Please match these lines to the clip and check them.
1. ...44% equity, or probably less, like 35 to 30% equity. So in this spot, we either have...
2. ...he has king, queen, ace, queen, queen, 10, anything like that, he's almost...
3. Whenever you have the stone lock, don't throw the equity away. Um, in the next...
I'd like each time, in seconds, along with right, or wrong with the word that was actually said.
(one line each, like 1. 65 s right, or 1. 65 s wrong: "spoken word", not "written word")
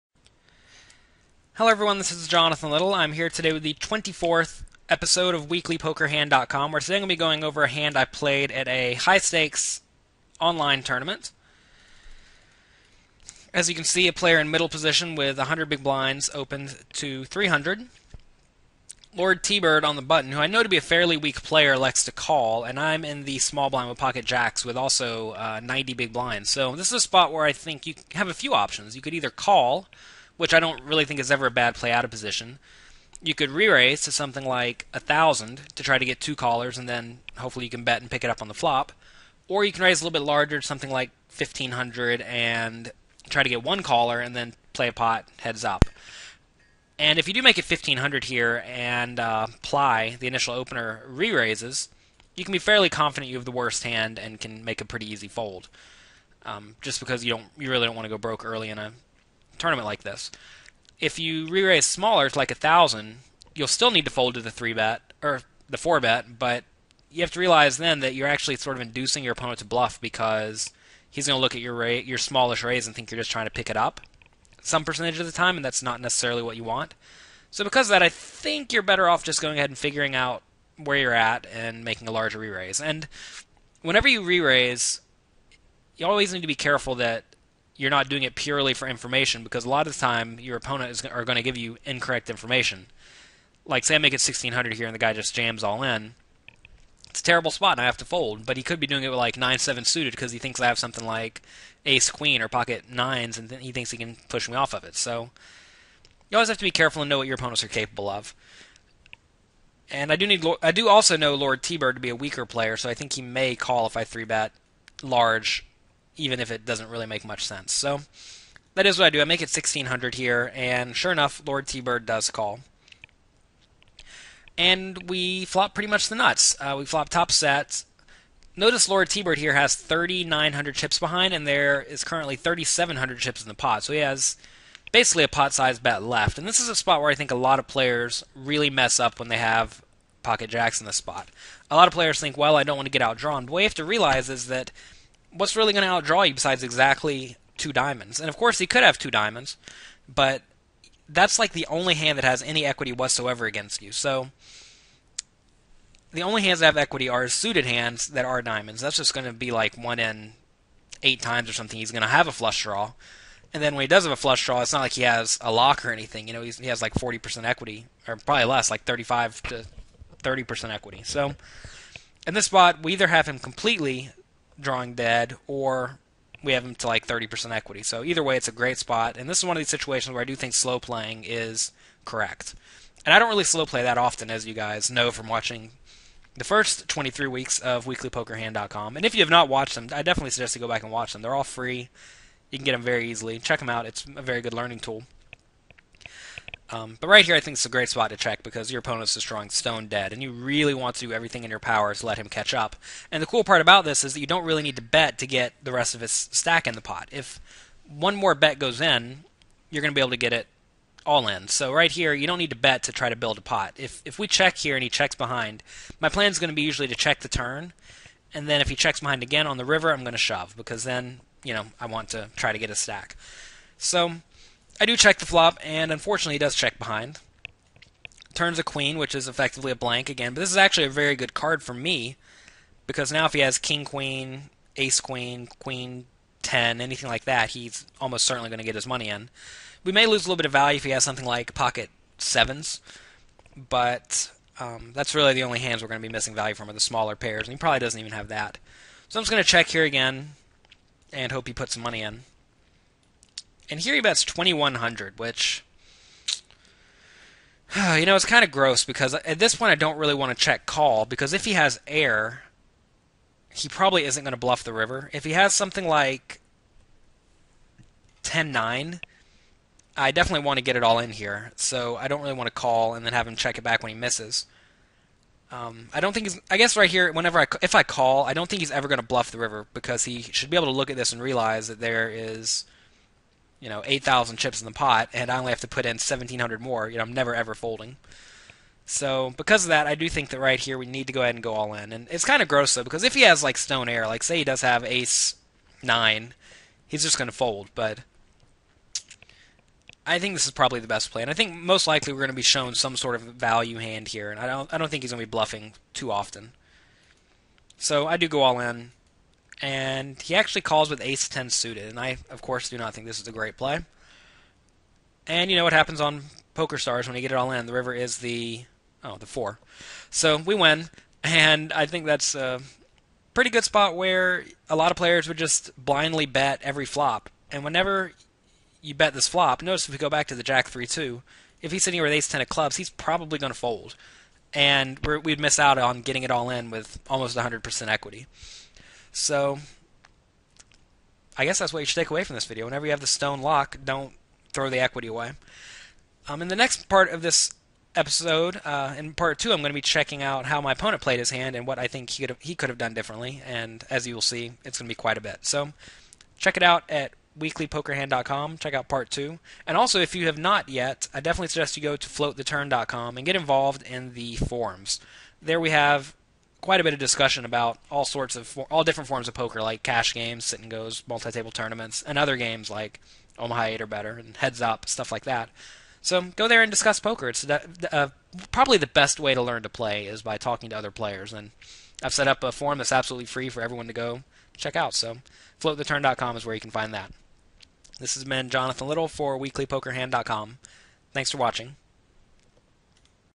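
1. 166 s wrong: "40", not "44"
2. 233 s right
3. 342 s right.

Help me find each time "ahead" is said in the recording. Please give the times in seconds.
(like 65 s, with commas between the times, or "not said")
79 s, 291 s.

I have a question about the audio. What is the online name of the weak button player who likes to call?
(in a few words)
Lord T Bird.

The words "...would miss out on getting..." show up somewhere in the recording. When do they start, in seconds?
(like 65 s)
335 s.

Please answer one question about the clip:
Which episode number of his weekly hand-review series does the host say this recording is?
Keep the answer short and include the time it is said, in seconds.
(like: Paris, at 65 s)
24th, at 3 s.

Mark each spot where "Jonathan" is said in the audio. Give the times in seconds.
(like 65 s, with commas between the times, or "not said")
2 s, 388 s.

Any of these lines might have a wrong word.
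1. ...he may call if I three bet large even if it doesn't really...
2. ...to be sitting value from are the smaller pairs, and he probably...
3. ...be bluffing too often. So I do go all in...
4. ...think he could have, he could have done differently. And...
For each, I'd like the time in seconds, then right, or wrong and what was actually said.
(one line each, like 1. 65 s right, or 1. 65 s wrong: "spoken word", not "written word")
1. 113 s right
2. 246 s wrong: "missing", not "sitting"
3. 305 s right
4. 351 s right.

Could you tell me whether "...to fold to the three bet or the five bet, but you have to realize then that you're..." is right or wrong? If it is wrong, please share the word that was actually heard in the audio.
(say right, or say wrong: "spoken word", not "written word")
wrong: "four", not "five".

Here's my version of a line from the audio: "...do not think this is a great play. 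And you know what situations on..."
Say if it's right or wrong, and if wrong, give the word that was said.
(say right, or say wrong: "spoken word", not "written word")
wrong: "happens", not "situations".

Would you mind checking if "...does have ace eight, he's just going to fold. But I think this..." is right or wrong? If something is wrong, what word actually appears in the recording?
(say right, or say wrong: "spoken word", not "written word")
wrong: "nine", not "eight".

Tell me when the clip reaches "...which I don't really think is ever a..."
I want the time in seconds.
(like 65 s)
30 s.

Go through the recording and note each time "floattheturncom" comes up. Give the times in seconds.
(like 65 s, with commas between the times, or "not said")
362 s, 385 s.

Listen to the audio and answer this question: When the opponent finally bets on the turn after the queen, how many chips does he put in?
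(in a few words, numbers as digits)
2100.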